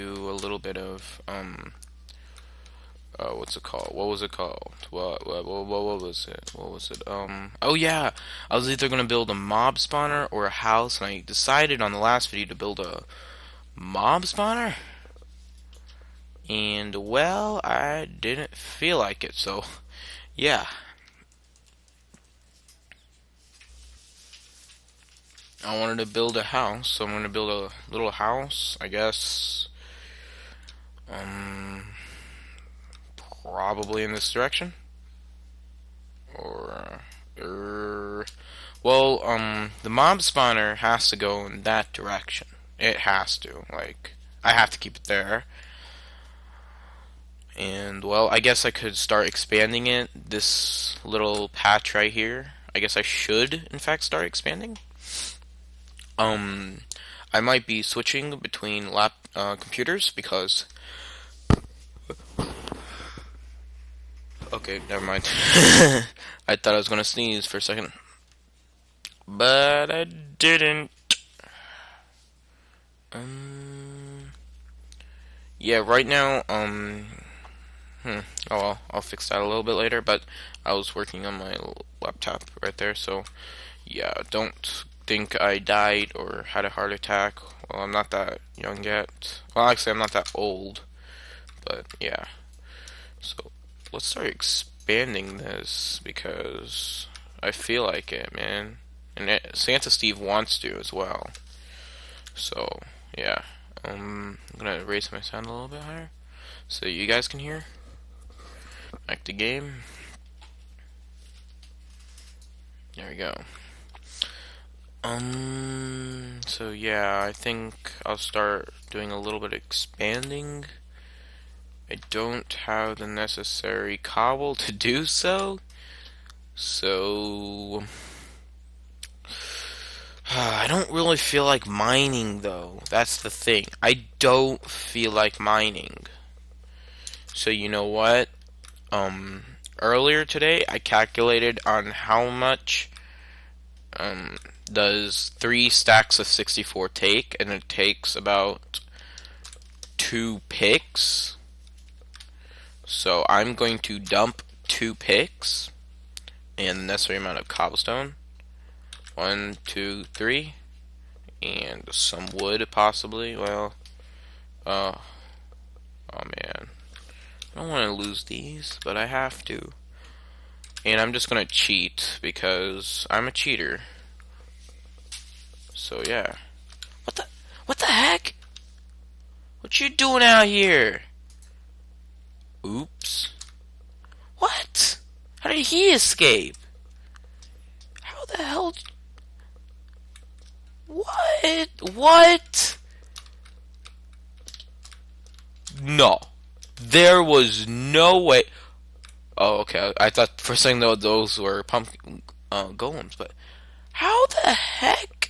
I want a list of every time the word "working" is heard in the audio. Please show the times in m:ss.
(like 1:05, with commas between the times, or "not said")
1:20.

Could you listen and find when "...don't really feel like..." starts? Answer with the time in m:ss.
2:10.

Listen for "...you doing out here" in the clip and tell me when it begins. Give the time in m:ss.
2:59.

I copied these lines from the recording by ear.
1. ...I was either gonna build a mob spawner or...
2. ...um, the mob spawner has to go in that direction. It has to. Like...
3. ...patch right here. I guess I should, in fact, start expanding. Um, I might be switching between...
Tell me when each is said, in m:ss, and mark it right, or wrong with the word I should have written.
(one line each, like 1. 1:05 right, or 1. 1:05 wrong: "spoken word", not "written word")
1. 0:08 right
2. 0:39 right
3. 0:51 right.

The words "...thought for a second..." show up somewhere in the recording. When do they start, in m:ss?
3:20.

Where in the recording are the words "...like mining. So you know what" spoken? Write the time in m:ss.
2:15.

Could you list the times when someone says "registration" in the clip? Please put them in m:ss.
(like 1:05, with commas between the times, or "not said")
not said.